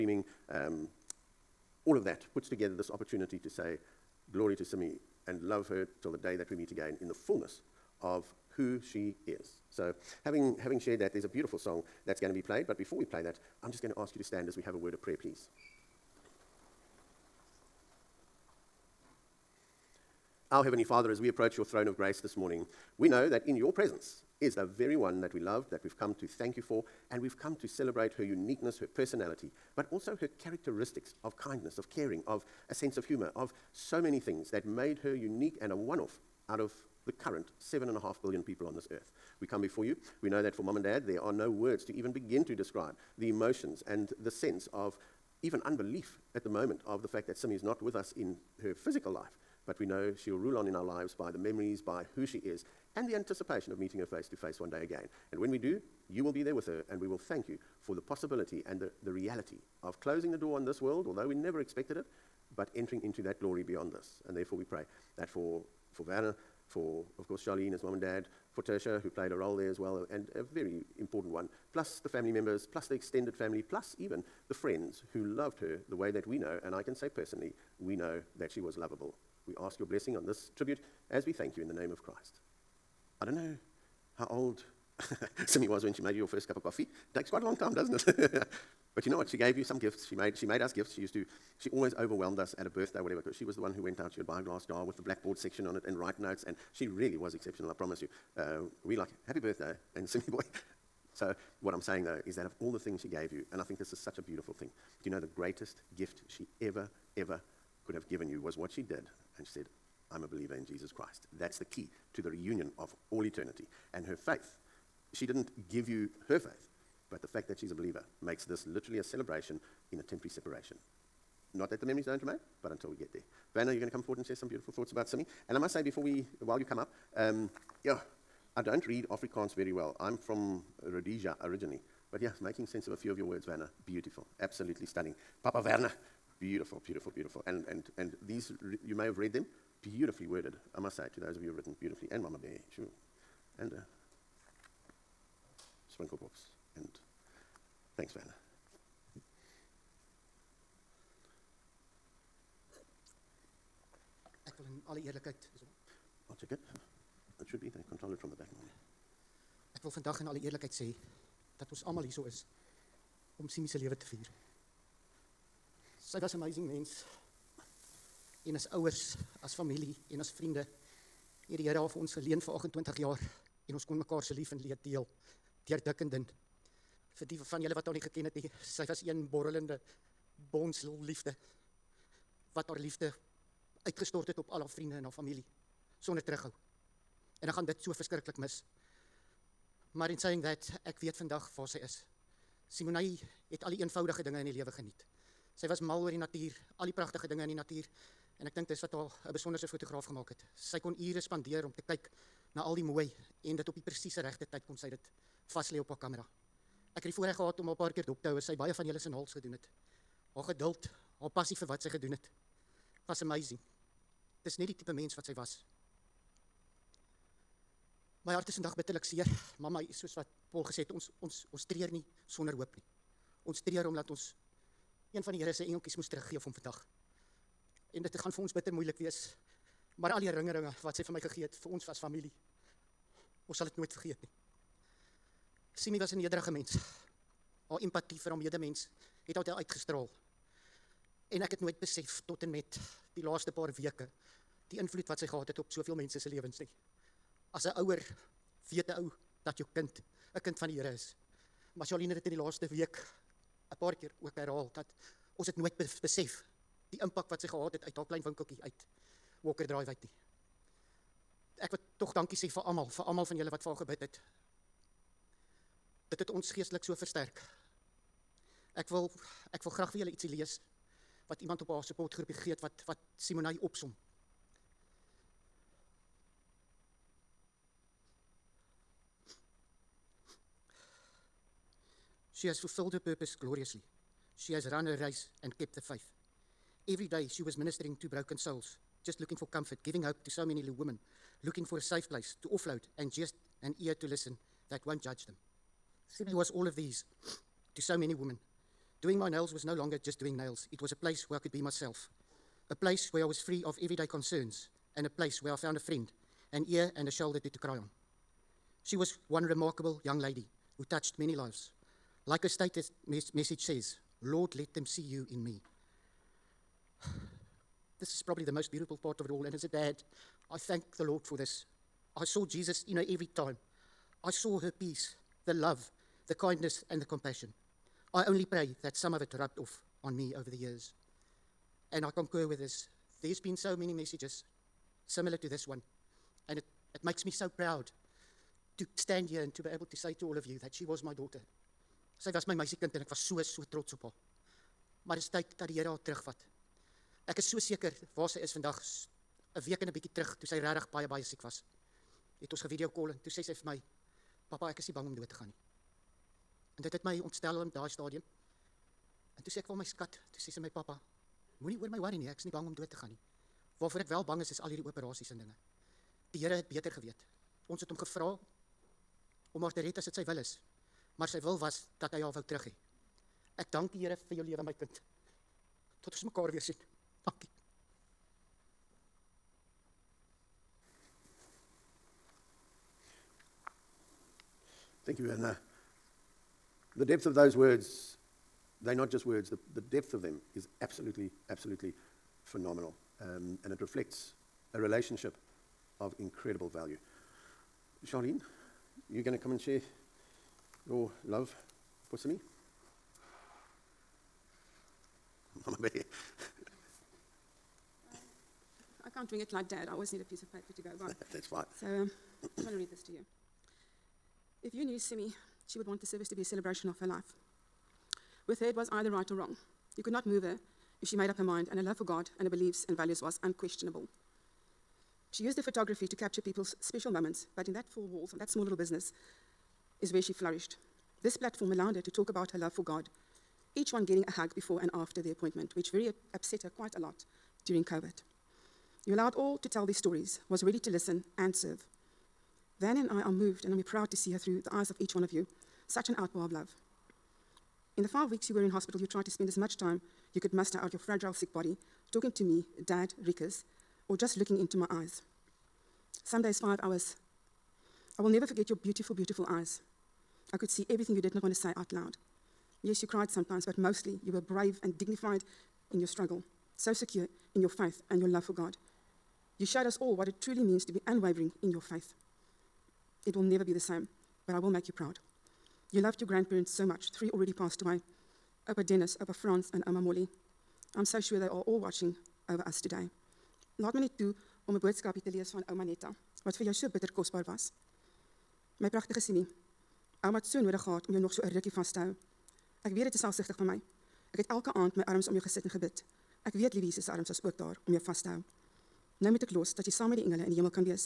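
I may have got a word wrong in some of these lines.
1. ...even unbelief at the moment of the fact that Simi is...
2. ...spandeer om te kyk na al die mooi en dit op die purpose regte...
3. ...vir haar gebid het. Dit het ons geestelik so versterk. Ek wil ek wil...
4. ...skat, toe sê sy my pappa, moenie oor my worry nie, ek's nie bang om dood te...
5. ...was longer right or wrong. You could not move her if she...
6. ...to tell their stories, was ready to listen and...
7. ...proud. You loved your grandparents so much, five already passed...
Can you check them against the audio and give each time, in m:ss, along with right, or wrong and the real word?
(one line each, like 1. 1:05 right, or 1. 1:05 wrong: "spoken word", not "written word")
1. 0:45 right
2. 3:21 wrong: "presiese", not "purpose"
3. 4:23 right
4. 5:59 right
5. 6:58 wrong: "either", not "longer"
6. 7:19 right
7. 7:54 wrong: "three", not "five".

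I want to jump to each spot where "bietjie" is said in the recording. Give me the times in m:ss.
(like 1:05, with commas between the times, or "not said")
5:49.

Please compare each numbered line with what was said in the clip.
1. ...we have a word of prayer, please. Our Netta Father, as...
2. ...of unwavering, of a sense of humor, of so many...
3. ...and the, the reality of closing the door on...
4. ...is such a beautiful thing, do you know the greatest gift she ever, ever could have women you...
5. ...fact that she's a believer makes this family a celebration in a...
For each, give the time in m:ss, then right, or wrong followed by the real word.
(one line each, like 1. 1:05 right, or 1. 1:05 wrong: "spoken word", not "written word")
1. 0:14 wrong: "Heavenly", not "Netta"
2. 0:31 wrong: "caring", not "unwavering"
3. 0:58 right
4. 1:43 wrong: "given", not "women"
5. 1:57 wrong: "literally", not "family".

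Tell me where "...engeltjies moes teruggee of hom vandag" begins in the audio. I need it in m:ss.
3:45.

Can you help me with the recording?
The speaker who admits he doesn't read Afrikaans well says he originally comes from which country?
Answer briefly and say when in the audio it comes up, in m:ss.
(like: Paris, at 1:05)
Rhodesia, at 2:10.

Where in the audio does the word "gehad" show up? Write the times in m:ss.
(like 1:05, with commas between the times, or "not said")
3:27, 4:05, 4:17, 8:10.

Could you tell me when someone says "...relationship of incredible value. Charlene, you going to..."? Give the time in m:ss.
6:34.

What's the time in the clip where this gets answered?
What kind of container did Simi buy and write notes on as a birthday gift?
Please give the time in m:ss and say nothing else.
1:34.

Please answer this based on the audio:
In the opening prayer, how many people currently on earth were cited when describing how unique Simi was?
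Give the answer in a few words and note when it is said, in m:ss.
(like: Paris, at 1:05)
7.5 billion, at 0:37.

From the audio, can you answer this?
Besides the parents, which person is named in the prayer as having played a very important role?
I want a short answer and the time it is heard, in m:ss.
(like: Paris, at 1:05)
Tertia, at 1:08.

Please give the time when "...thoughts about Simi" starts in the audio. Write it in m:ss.
2:04.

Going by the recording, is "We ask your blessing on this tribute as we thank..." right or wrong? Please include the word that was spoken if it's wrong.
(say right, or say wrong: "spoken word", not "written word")
right.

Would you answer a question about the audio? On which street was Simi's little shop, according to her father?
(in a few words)
Walker Drive.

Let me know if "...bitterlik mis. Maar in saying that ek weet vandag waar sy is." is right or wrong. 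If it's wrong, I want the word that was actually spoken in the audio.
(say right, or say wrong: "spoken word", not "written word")
wrong: "verskriklik", not "bitterlik".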